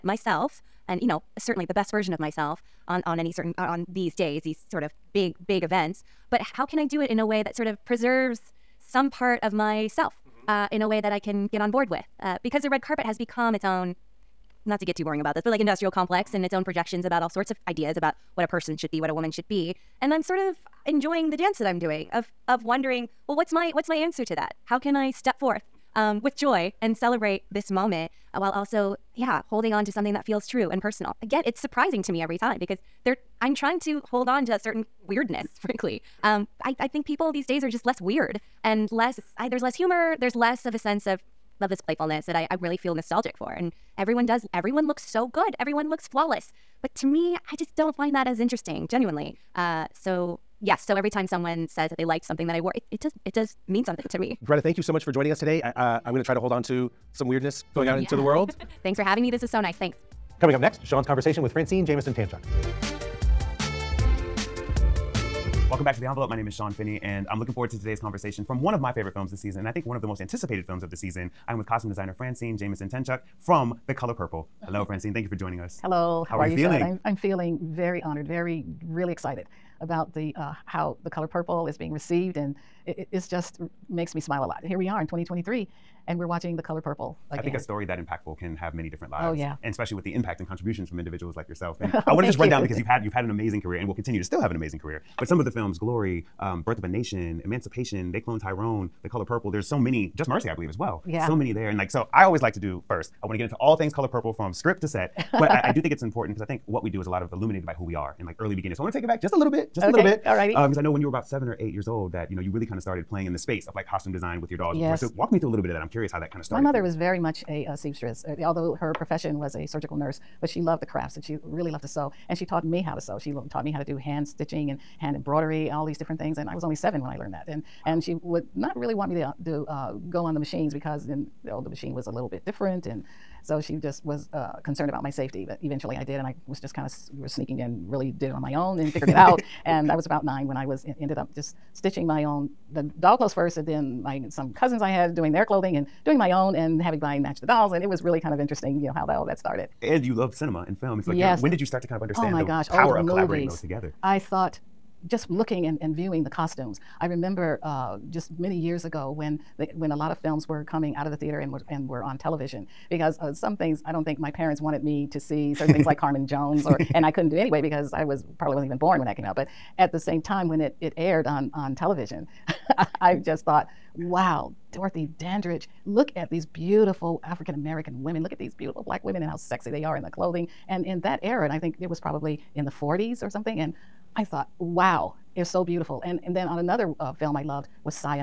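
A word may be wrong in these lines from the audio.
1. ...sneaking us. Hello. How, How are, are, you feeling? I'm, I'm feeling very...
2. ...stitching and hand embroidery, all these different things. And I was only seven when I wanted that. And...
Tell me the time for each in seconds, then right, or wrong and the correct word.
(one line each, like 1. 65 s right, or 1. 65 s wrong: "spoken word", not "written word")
1. 75 s wrong: "joining", not "sneaking"
2. 124 s wrong: "learned", not "wanted".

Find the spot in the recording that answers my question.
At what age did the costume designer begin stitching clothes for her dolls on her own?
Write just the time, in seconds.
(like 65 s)
140 s.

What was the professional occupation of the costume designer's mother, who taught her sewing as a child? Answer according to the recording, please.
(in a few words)
surgical nurse.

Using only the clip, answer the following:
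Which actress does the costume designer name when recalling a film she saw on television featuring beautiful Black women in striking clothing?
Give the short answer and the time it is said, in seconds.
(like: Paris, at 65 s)
Dorothy Dandridge, at 174 s.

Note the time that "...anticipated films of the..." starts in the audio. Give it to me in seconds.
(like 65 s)
70 s.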